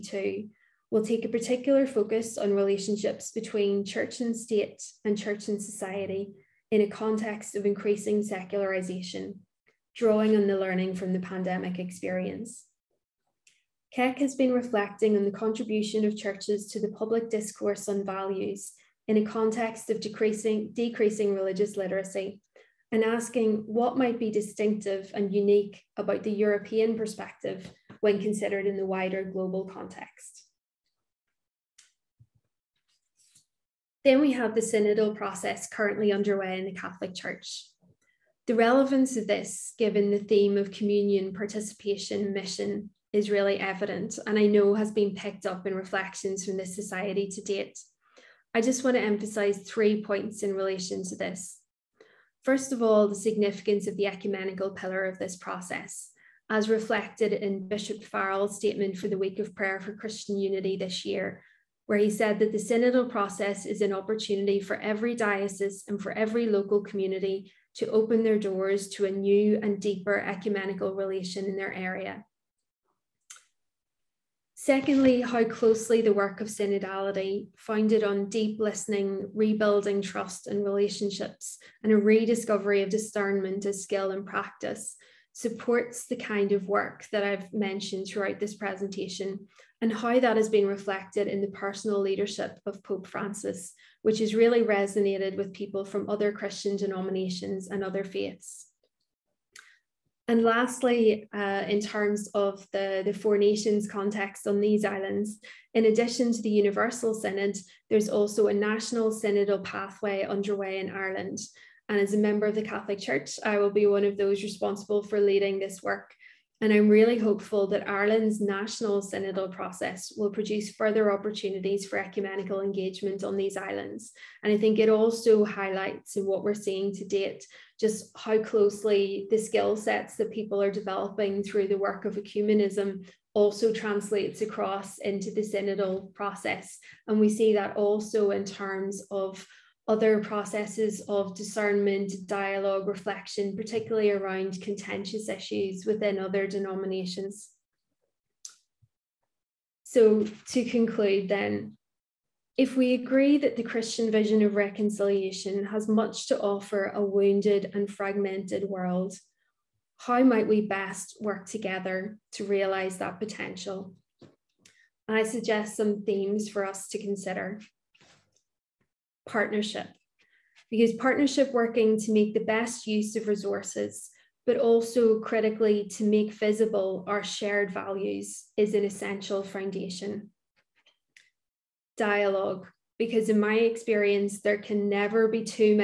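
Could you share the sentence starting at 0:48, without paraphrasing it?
I just want to emphasize three points in relation to this.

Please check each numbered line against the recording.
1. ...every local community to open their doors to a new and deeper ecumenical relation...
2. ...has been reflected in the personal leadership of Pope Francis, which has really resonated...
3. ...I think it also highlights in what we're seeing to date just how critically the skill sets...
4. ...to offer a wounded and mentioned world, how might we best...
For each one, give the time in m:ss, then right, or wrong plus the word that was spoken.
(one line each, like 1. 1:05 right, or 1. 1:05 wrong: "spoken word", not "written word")
1. 1:06 right
2. 1:30 right
3. 2:04 wrong: "closely", not "critically"
4. 2:36 wrong: "fragmented", not "mentioned".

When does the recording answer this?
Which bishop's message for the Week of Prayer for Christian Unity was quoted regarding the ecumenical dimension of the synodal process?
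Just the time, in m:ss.
0:57.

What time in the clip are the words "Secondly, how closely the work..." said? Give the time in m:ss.
1:14.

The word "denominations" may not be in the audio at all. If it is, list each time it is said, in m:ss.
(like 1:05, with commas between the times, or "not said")
1:36, 2:26.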